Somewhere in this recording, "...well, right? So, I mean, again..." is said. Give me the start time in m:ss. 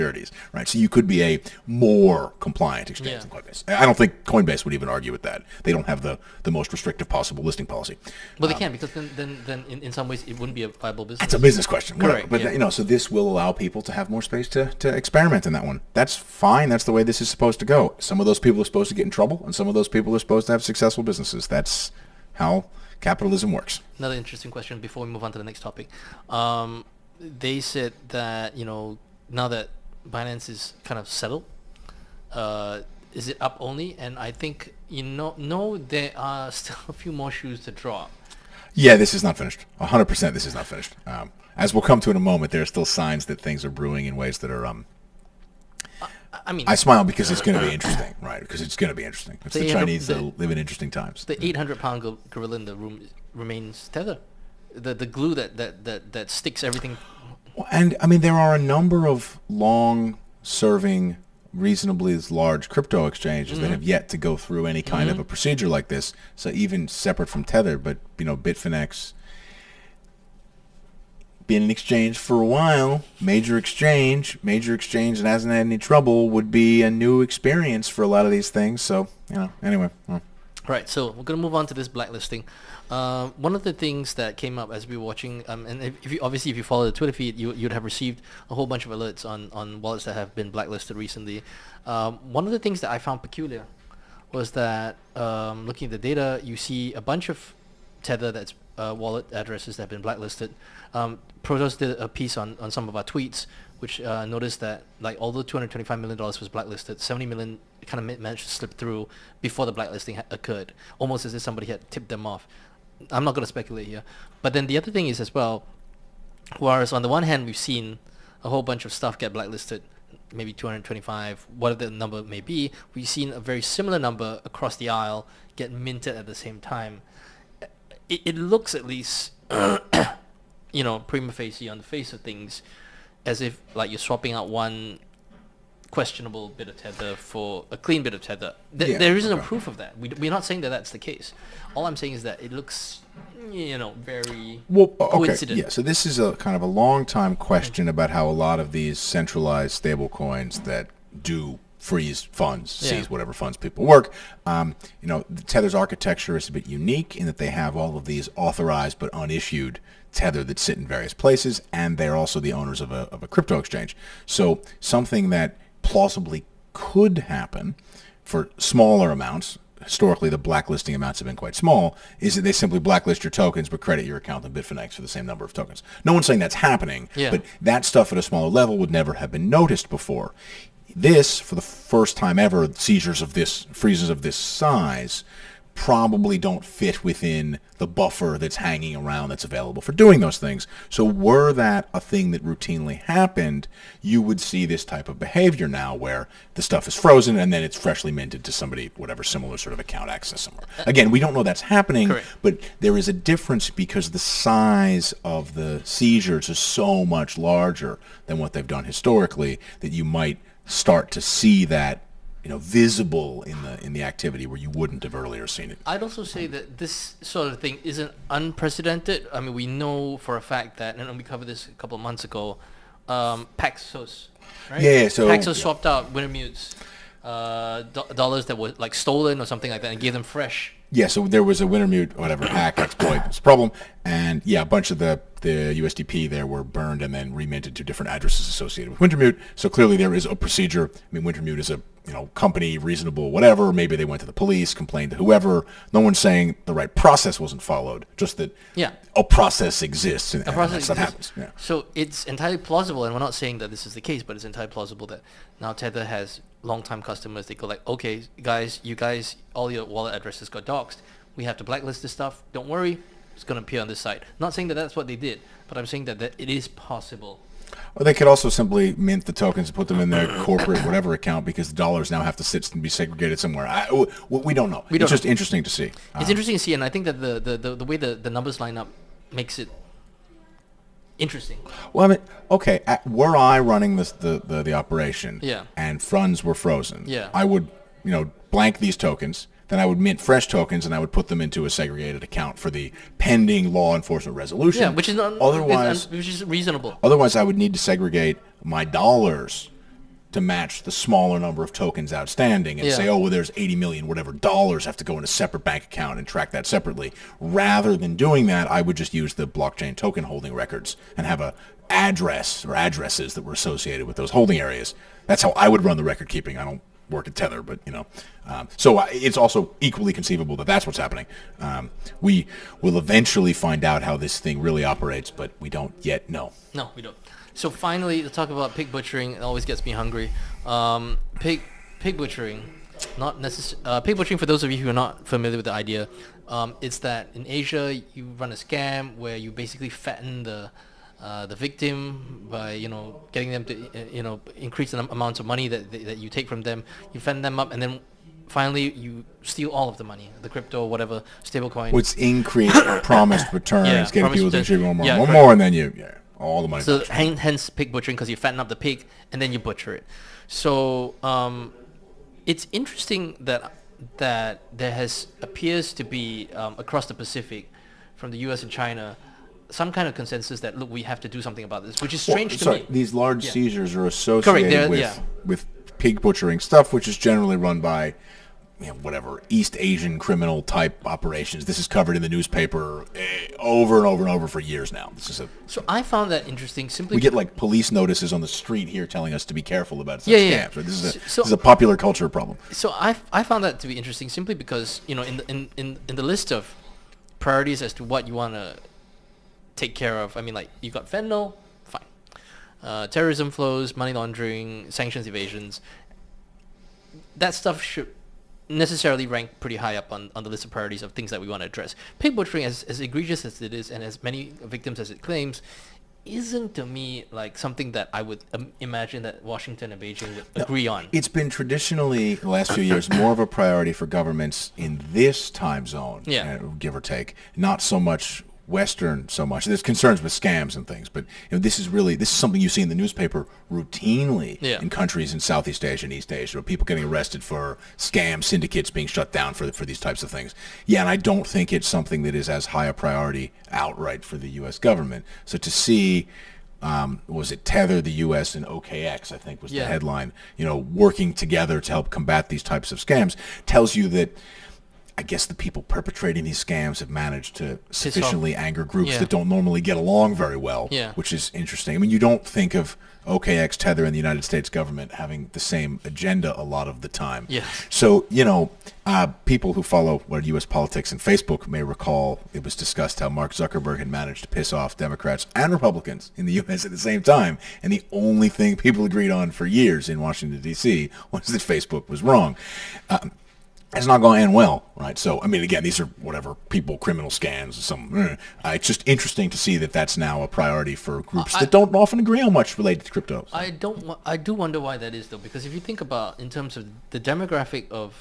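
8:04.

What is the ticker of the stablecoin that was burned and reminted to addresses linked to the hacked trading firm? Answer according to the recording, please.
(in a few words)
USDP.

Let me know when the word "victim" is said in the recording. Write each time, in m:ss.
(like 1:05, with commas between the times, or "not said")
5:41, 6:54.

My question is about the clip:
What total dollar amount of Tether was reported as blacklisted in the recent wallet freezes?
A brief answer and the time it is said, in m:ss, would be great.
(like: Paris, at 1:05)
$225 million, at 1:45.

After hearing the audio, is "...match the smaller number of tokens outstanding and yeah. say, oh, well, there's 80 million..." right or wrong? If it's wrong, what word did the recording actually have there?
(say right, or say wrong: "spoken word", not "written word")
right.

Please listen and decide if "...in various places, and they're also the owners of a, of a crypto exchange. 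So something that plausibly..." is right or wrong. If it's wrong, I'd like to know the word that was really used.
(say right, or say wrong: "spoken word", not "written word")
right.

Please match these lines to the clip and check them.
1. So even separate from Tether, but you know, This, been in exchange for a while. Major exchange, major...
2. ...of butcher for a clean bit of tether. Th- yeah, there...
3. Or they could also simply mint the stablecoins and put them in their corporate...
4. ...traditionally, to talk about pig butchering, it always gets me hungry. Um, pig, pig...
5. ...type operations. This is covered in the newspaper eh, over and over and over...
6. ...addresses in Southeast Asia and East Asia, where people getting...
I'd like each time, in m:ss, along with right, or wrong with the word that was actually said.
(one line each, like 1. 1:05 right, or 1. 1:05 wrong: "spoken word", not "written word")
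1. 1:06 wrong: "Bitfinex", not "This"
2. 2:16 wrong: "tether", not "butcher"
3. 4:27 wrong: "tokens", not "stablecoins"
4. 5:27 wrong: "finally", not "traditionally"
5. 6:20 right
6. 7:14 wrong: "countries", not "addresses".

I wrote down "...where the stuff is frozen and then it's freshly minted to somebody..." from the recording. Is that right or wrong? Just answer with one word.
right.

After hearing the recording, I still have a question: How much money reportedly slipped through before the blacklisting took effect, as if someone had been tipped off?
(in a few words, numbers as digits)
$70 million.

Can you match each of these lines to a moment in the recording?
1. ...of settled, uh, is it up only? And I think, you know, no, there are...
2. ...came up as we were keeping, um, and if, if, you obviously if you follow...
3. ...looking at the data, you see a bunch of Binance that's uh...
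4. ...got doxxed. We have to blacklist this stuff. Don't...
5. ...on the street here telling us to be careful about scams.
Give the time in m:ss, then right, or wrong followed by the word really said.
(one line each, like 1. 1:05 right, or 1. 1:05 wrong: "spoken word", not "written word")
1. 0:30 right
2. 1:24 wrong: "watching", not "keeping"
3. 1:35 wrong: "Tether", not "Binance"
4. 4:20 right
5. 6:28 right.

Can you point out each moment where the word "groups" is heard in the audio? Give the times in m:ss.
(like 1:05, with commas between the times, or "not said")
7:38, 8:11.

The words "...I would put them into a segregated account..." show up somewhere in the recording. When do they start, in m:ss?
4:50.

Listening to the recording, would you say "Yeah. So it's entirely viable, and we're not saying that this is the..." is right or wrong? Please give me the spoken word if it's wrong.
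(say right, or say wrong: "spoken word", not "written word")
wrong: "plausible", not "viable".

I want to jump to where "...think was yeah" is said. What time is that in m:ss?
7:29.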